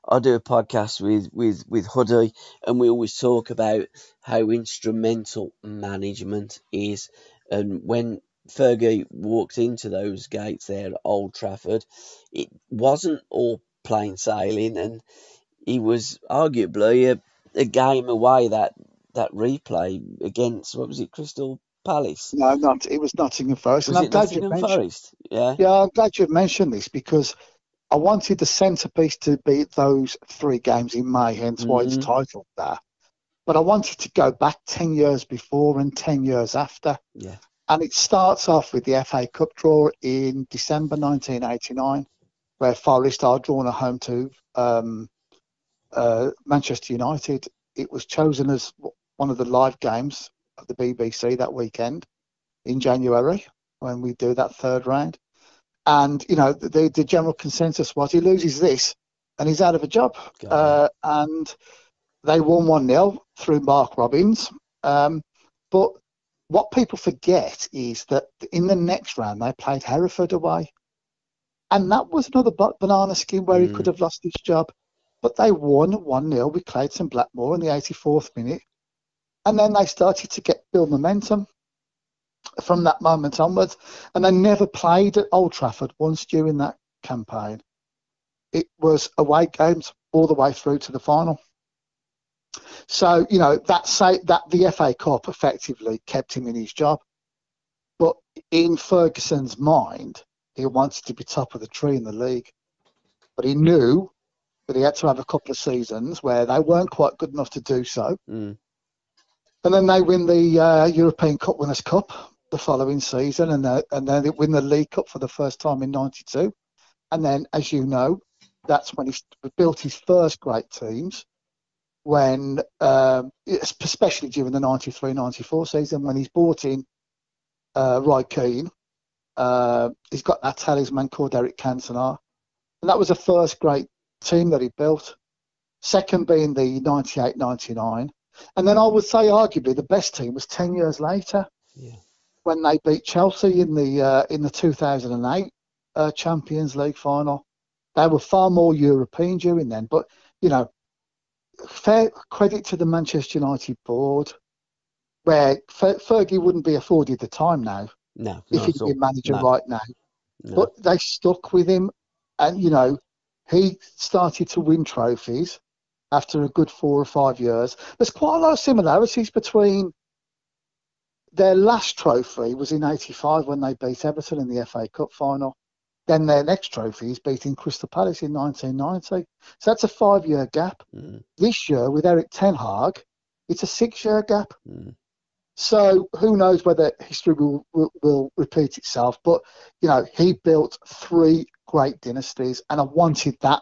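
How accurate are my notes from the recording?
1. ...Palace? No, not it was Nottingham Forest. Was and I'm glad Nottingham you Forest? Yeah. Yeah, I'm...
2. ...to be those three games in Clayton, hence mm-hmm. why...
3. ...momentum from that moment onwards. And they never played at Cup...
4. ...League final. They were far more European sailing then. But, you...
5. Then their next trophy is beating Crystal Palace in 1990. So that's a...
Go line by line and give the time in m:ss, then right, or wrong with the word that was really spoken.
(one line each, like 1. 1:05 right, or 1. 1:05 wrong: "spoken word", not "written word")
1. 0:21 right
2. 0:29 wrong: "May", not "Clayton"
3. 1:20 wrong: "Old", not "Cup"
4. 2:26 wrong: "during", not "sailing"
5. 2:56 right.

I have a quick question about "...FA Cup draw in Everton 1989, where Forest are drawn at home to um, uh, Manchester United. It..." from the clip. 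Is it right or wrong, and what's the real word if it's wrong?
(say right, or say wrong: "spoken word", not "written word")
wrong: "December", not "Everton".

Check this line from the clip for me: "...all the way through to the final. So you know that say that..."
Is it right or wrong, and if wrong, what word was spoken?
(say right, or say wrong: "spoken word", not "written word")
right.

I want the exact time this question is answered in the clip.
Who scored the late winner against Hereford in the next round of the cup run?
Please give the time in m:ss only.
1:16.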